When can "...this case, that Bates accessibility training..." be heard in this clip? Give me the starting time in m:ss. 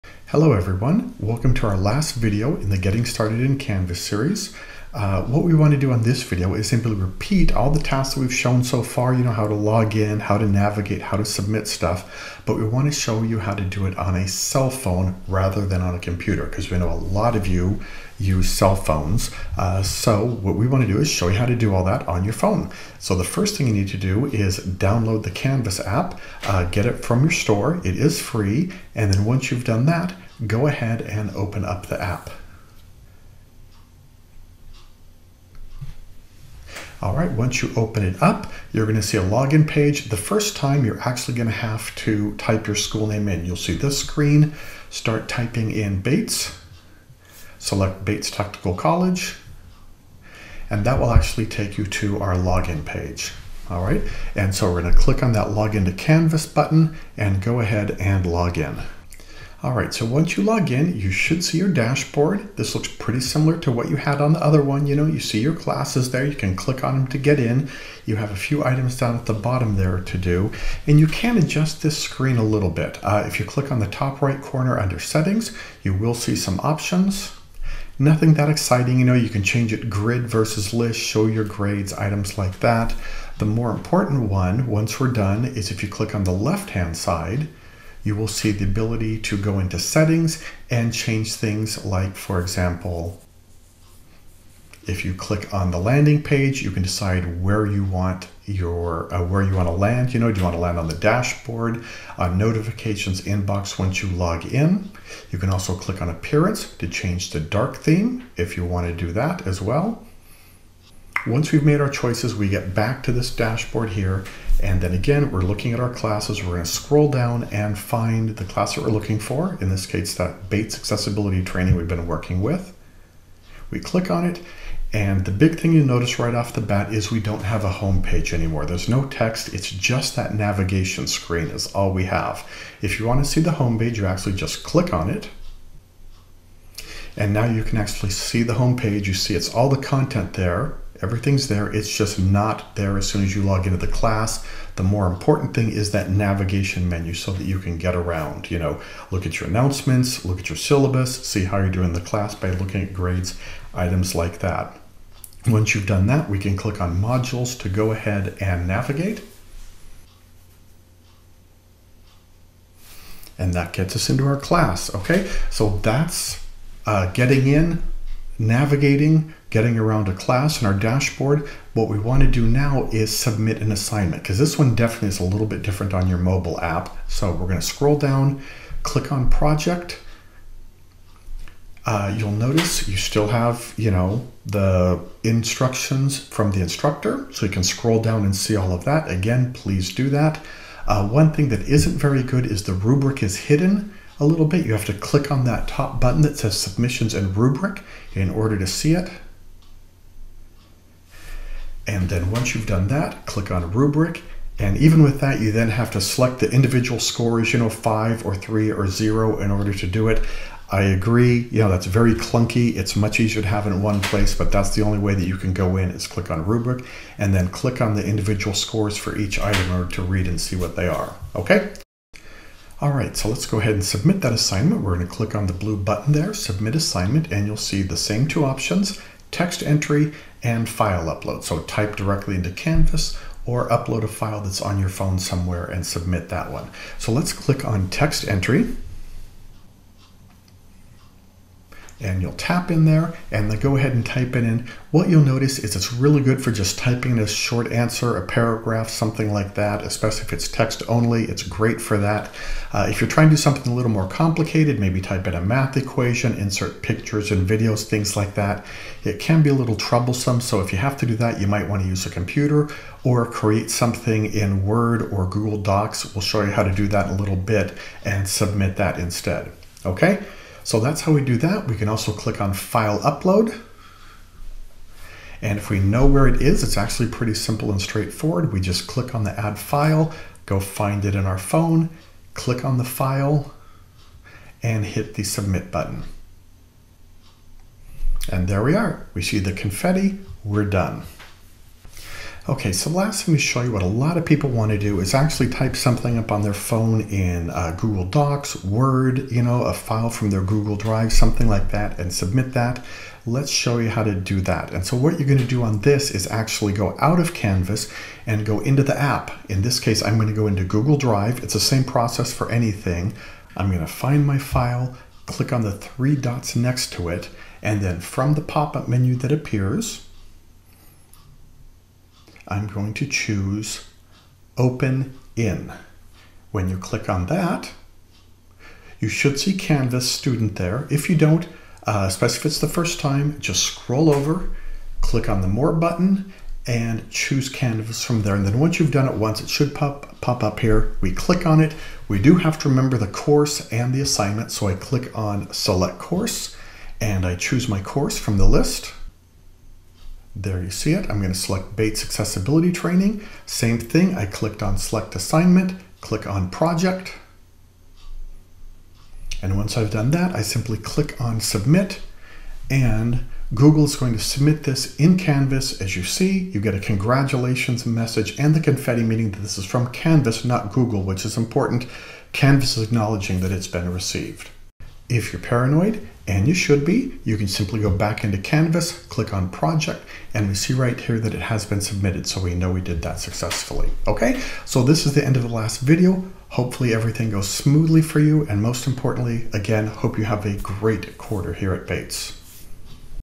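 1:59.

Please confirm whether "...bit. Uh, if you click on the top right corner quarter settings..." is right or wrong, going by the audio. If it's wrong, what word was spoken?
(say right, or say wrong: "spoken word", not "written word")
wrong: "under", not "quarter".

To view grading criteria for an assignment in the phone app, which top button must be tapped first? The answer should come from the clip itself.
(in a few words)
submissions and rubric.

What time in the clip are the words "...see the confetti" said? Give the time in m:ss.
4:49.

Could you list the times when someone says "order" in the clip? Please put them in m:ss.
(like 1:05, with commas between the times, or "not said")
3:18, 3:29, 3:39.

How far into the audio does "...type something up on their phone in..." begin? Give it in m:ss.
4:55.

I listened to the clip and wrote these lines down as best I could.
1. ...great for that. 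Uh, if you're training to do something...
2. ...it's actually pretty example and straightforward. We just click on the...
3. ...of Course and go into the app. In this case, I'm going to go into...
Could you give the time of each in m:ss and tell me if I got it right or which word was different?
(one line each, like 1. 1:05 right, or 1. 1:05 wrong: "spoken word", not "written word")
1. 4:11 wrong: "trying", not "training"
2. 4:36 wrong: "simple", not "example"
3. 5:07 wrong: "Canvas", not "Course".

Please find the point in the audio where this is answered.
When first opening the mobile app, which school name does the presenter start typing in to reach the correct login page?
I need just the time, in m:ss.
0:48.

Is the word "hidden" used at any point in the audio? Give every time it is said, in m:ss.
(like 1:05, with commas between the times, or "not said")
3:13.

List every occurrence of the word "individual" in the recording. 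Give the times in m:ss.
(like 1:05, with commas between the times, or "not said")
3:26, 3:38.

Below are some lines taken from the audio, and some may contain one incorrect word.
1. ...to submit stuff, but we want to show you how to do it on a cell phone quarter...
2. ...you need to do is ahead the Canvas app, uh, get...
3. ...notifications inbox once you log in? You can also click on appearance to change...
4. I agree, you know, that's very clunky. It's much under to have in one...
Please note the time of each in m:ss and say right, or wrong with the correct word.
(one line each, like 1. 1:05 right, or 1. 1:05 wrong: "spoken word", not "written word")
1. 0:11 wrong: "rather", not "quarter"
2. 0:23 wrong: "download", not "ahead"
3. 1:42 right
4. 3:30 wrong: "easier", not "under".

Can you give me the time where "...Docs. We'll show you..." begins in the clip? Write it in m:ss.
4:25.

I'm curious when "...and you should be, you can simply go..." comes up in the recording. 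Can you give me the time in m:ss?
6:16.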